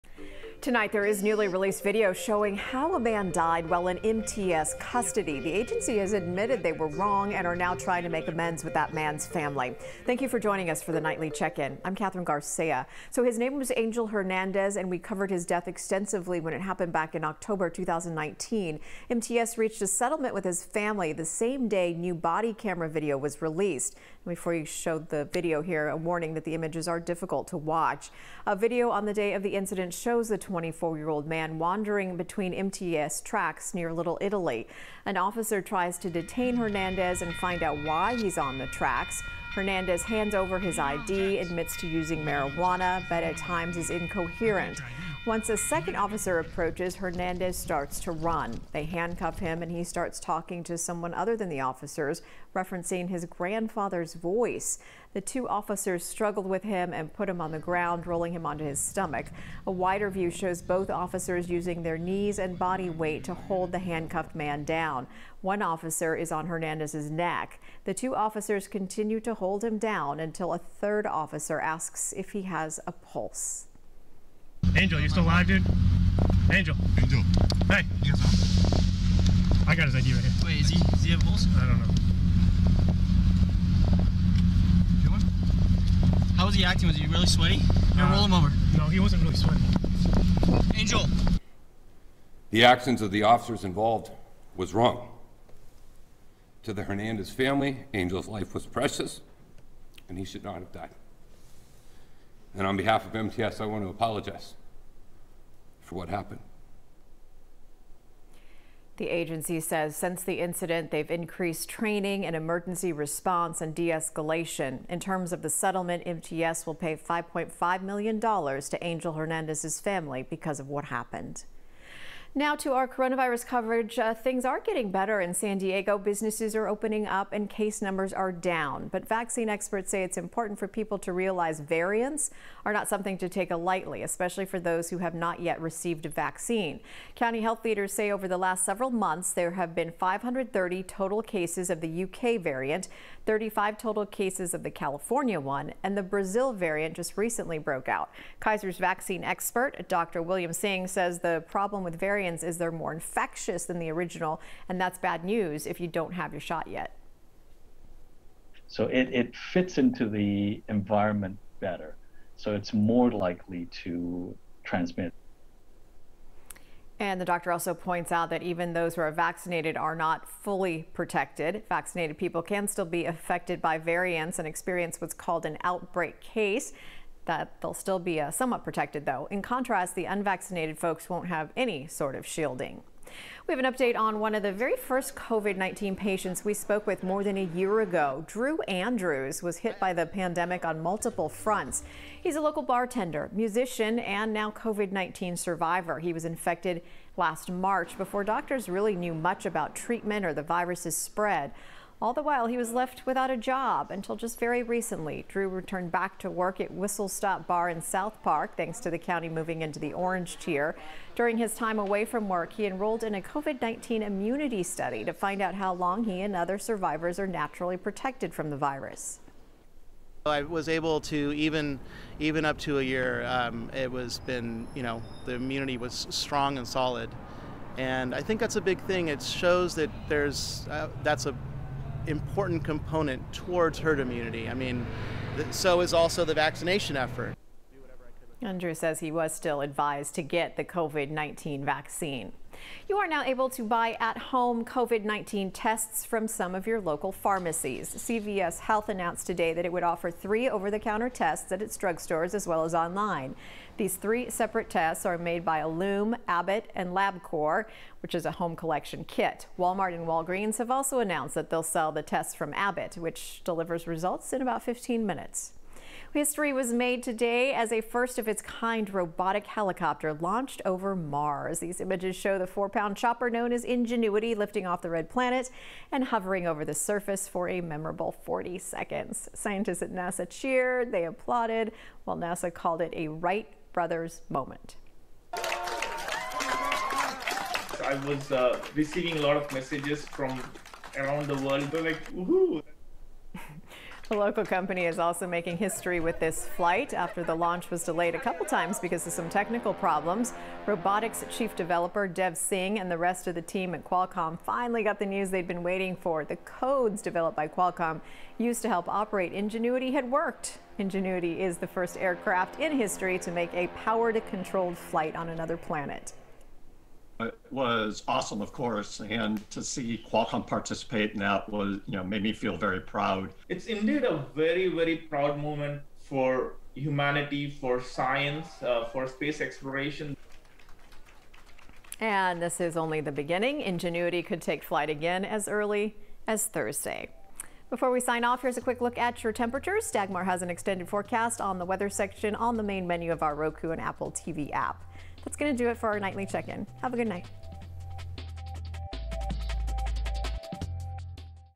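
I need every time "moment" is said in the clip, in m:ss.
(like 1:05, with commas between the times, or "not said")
4:44, 5:25.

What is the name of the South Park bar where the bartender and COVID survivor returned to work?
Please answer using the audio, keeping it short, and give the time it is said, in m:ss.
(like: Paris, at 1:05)
Whistle Stop Bar, at 3:26.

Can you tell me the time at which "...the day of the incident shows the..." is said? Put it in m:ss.
0:29.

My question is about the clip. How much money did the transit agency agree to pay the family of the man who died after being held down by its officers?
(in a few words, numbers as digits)
$5.5 million.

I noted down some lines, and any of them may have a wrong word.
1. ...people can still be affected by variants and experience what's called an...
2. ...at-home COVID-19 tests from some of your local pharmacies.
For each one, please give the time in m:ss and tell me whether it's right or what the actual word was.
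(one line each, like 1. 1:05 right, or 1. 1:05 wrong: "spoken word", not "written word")
1. 2:52 right
2. 4:03 right.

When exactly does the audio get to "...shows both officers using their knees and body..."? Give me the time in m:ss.
1:00.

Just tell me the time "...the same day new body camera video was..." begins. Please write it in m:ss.
0:21.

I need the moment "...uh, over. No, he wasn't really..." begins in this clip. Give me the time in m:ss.
1:28.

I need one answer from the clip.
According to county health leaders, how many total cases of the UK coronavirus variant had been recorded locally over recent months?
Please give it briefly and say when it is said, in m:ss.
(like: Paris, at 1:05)
530, at 2:19.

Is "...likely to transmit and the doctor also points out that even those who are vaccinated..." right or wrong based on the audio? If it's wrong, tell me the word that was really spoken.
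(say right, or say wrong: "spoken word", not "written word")
right.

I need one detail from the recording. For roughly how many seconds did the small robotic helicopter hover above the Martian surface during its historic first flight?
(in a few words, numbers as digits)
40.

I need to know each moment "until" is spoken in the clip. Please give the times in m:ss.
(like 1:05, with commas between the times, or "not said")
1:10, 3:23.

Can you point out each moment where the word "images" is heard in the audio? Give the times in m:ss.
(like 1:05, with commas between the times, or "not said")
0:26, 4:31.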